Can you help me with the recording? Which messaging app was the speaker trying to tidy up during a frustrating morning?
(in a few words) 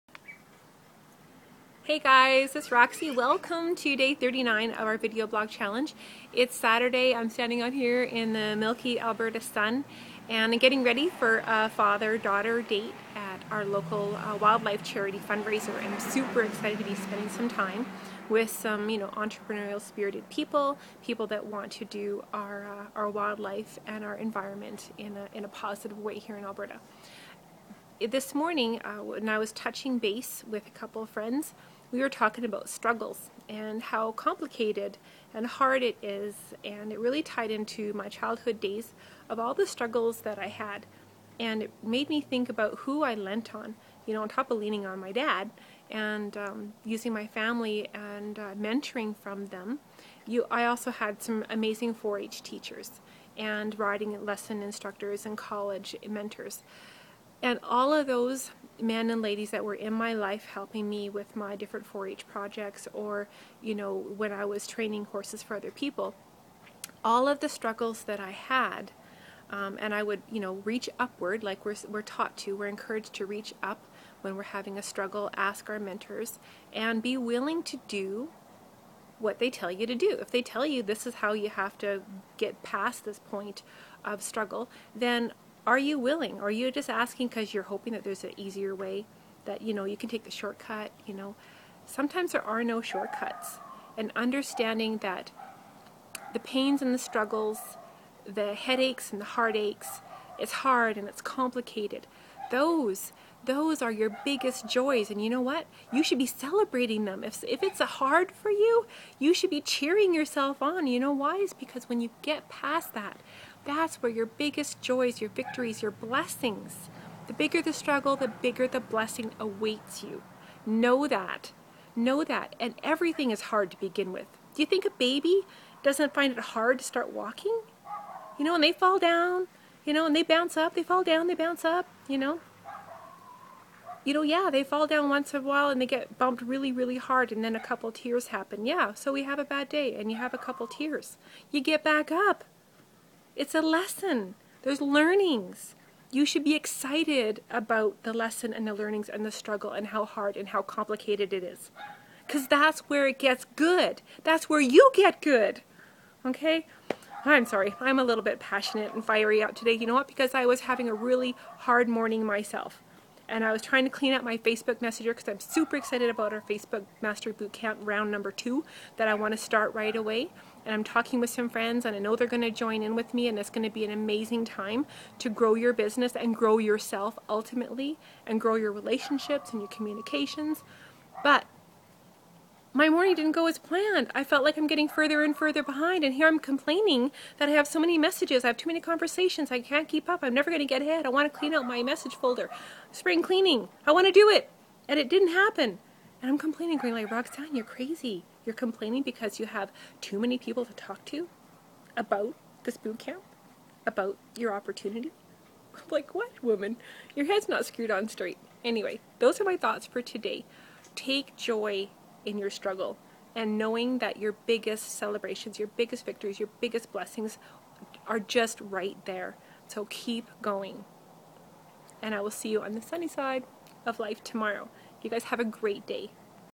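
Facebook Messenger.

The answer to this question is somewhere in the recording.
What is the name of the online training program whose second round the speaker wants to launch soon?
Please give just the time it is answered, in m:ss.
2:46.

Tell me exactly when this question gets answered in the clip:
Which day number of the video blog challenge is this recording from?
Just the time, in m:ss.
0:03.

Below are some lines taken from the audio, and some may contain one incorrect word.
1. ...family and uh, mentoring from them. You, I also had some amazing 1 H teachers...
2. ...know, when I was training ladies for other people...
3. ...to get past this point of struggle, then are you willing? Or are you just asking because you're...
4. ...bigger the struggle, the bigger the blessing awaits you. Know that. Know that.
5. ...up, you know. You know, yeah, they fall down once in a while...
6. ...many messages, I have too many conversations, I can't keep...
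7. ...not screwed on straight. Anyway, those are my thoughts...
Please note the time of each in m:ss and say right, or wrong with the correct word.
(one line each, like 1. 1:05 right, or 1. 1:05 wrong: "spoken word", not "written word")
1. 0:47 wrong: "4", not "1"
2. 1:03 wrong: "horses", not "ladies"
3. 1:21 right
4. 1:57 right
5. 2:11 right
6. 3:07 right
7. 3:27 right.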